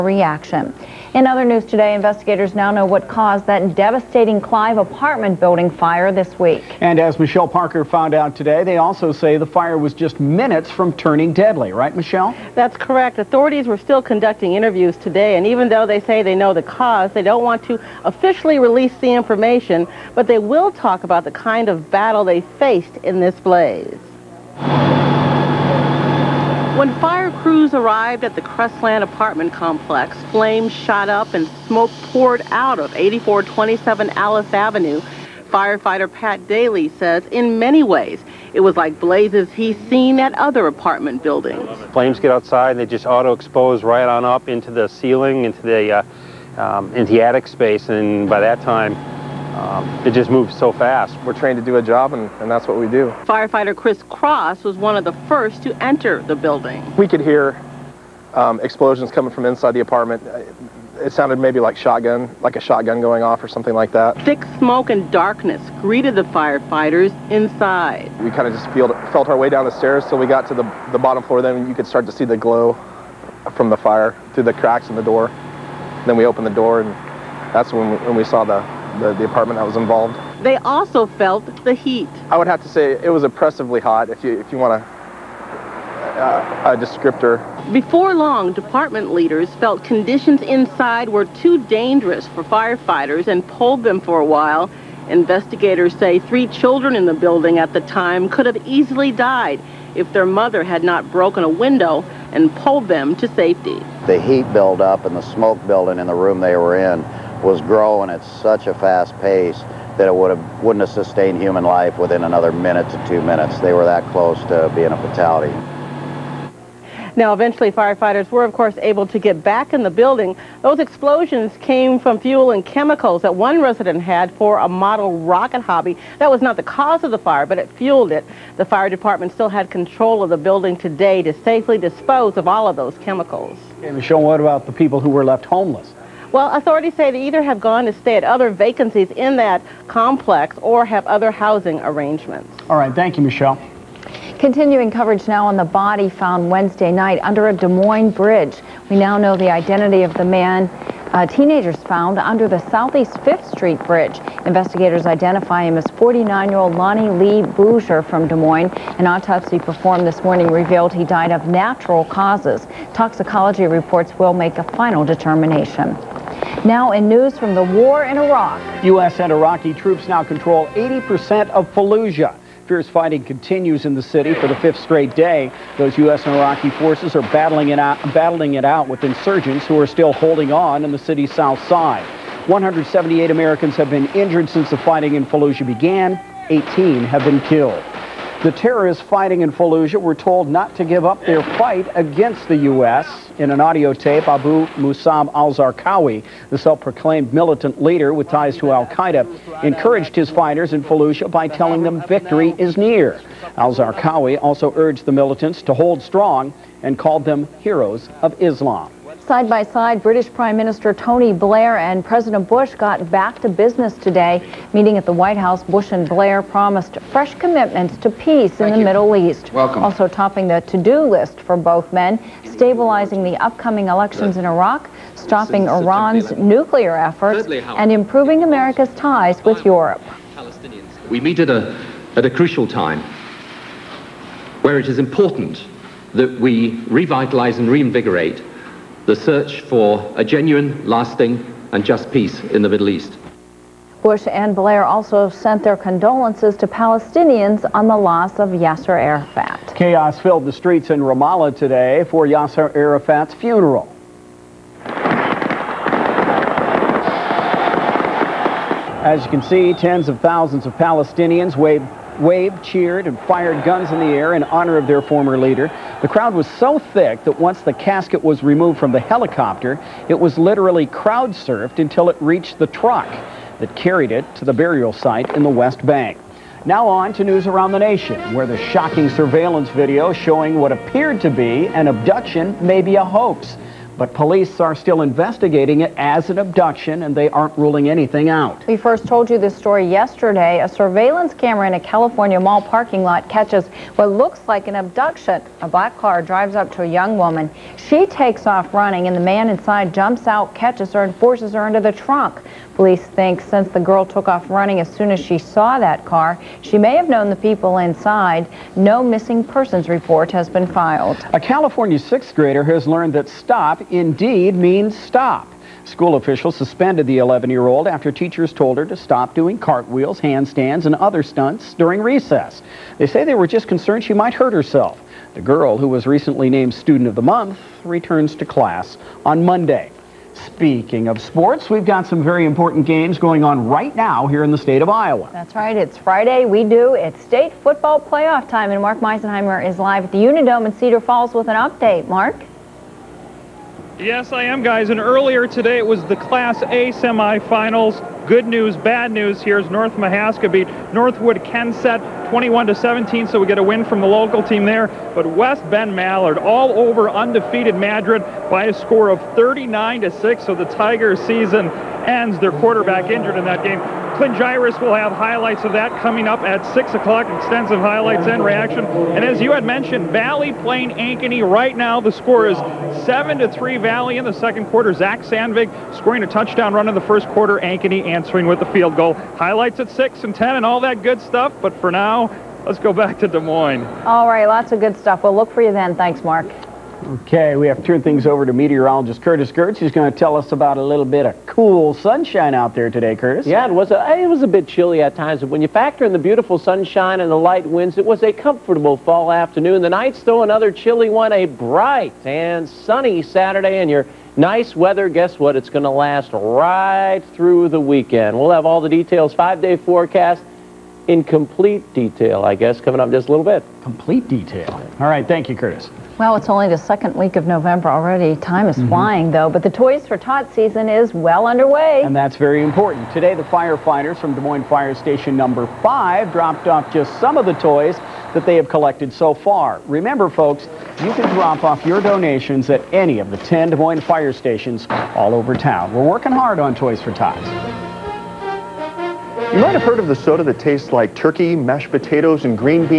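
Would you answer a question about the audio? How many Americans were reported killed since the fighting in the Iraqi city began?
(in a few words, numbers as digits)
18.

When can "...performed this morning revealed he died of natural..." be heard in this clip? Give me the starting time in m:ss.
2:39.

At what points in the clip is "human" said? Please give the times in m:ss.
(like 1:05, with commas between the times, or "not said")
1:51.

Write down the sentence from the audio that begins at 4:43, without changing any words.
But police are still investigating it as an abduction, and they aren't ruling anything out.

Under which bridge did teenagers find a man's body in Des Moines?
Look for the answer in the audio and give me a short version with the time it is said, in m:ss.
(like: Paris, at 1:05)
Southeast 5th Street Bridge, at 2:32.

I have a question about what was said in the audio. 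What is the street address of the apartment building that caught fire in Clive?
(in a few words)
8427 Alice Avenue.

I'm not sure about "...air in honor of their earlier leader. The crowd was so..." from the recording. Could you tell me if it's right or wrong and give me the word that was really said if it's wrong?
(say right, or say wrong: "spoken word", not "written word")
wrong: "former", not "earlier".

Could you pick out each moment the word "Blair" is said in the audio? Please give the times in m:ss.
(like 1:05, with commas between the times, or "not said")
3:31, 3:36, 4:04.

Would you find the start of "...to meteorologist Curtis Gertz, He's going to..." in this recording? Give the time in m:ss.
6:28.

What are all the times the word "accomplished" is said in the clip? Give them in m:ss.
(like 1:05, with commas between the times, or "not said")
not said.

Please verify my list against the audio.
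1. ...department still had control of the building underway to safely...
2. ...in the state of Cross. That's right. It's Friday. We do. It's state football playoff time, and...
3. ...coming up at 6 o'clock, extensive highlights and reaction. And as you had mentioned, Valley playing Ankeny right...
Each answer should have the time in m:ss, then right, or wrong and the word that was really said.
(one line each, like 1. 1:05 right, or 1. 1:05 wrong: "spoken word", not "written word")
1. 2:08 wrong: "today", not "underway"
2. 5:34 wrong: "Iowa", not "Cross"
3. 6:06 right.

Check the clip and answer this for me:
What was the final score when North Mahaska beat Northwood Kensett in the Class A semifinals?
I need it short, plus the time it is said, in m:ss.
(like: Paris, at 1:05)
21 to 17, at 5:52.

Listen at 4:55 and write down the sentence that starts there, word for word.
A black car drives up to a young woman.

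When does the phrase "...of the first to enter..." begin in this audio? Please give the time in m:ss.
0:54.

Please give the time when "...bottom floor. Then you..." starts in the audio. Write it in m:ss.
1:10.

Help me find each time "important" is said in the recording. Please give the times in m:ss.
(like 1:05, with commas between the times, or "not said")
3:54, 5:32, 7:02.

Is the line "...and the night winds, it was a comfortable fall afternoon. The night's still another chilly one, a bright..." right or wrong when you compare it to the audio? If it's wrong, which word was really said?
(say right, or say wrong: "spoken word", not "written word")
wrong: "light", not "night".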